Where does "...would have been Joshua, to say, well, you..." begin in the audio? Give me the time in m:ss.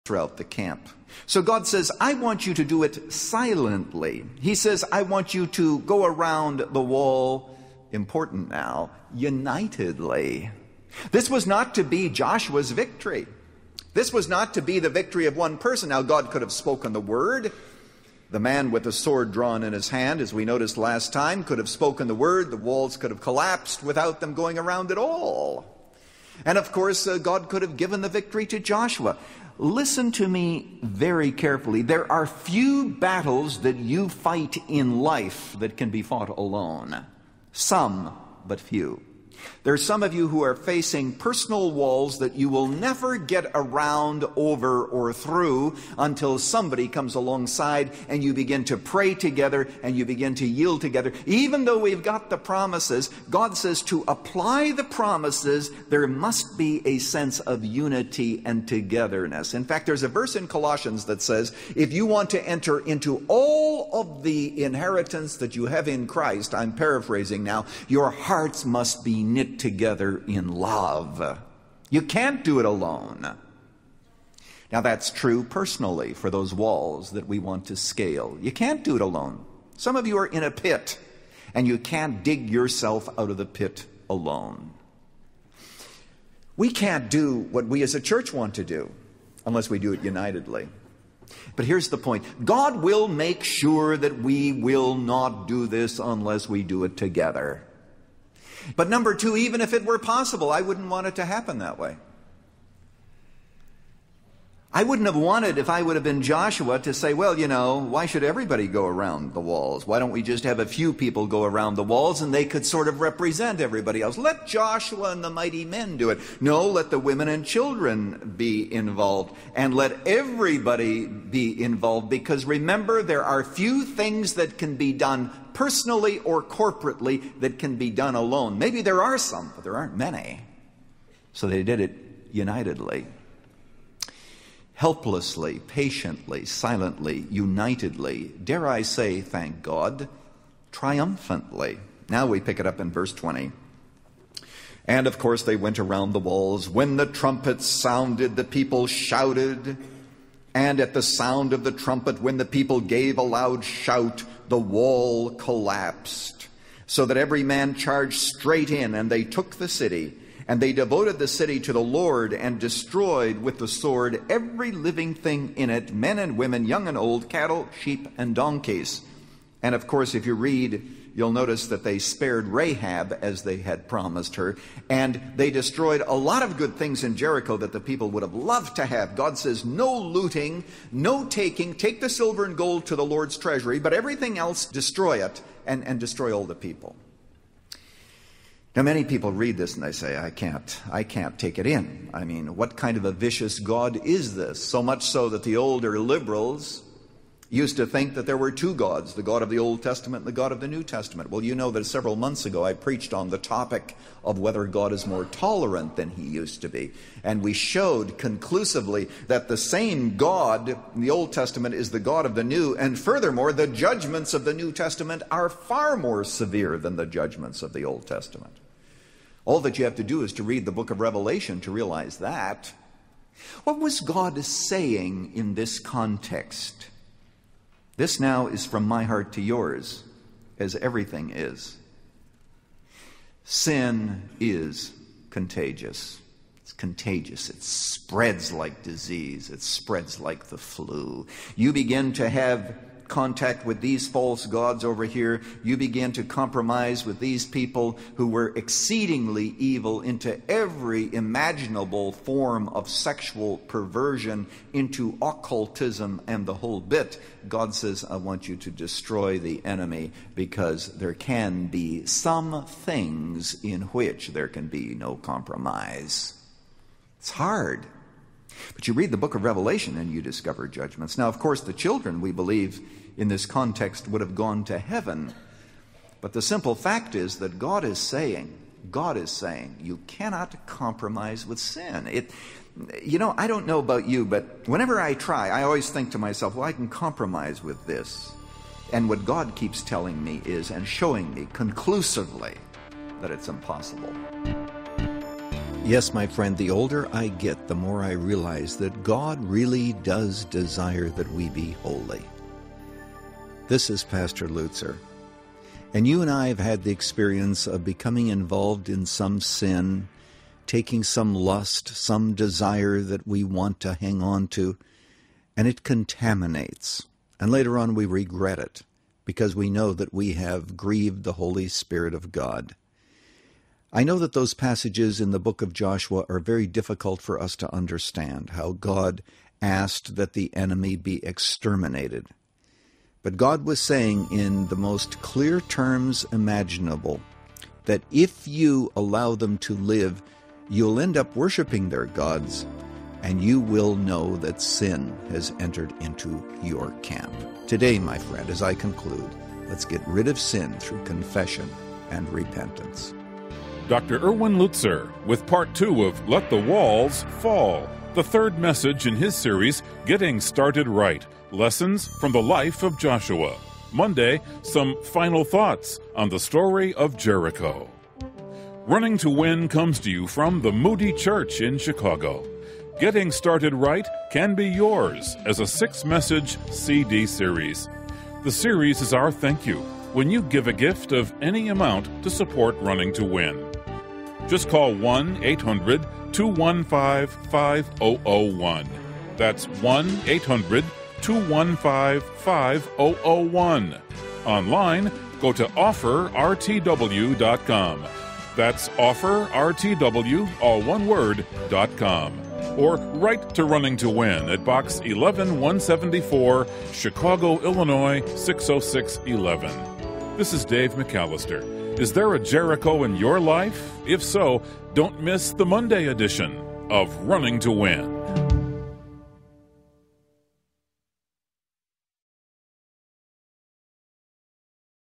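1:45.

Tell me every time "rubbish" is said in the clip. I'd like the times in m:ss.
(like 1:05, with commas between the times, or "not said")
not said.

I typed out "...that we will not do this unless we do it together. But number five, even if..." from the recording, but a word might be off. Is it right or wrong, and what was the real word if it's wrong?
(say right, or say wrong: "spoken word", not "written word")
wrong: "two", not "five".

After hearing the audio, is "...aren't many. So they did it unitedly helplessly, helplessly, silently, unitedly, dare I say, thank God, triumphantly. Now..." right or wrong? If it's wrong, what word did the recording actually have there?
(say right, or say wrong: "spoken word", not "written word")
wrong: "patiently", not "helplessly".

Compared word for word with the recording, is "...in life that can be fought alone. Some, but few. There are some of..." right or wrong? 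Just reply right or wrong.
right.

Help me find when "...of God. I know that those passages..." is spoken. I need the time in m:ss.
5:22.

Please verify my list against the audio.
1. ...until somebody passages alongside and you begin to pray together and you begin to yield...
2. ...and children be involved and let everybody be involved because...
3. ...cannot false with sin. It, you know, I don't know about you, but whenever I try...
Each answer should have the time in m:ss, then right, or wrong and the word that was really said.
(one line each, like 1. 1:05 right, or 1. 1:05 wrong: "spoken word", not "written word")
1. 0:45 wrong: "comes", not "passages"
2. 1:57 right
3. 4:40 wrong: "compromise", not "false".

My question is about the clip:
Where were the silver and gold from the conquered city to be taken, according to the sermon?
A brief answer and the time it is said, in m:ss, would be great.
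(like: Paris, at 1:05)
The Lord's treasury, at 3:02.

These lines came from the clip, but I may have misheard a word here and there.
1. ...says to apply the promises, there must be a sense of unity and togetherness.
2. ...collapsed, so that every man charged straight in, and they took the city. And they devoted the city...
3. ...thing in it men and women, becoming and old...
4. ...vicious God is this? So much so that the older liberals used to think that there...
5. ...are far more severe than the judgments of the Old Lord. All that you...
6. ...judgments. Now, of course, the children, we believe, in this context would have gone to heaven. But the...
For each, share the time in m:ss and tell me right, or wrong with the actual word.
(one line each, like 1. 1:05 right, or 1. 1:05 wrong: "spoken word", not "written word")
1. 0:53 right
2. 2:35 right
3. 2:45 wrong: "young", not "becoming"
4. 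3:13 right
5. 3:35 wrong: "Testament", not "Lord"
6. 4:30 right.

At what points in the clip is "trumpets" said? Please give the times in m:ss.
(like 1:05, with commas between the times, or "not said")
2:27, 2:31.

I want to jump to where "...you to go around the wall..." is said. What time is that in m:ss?
0:05.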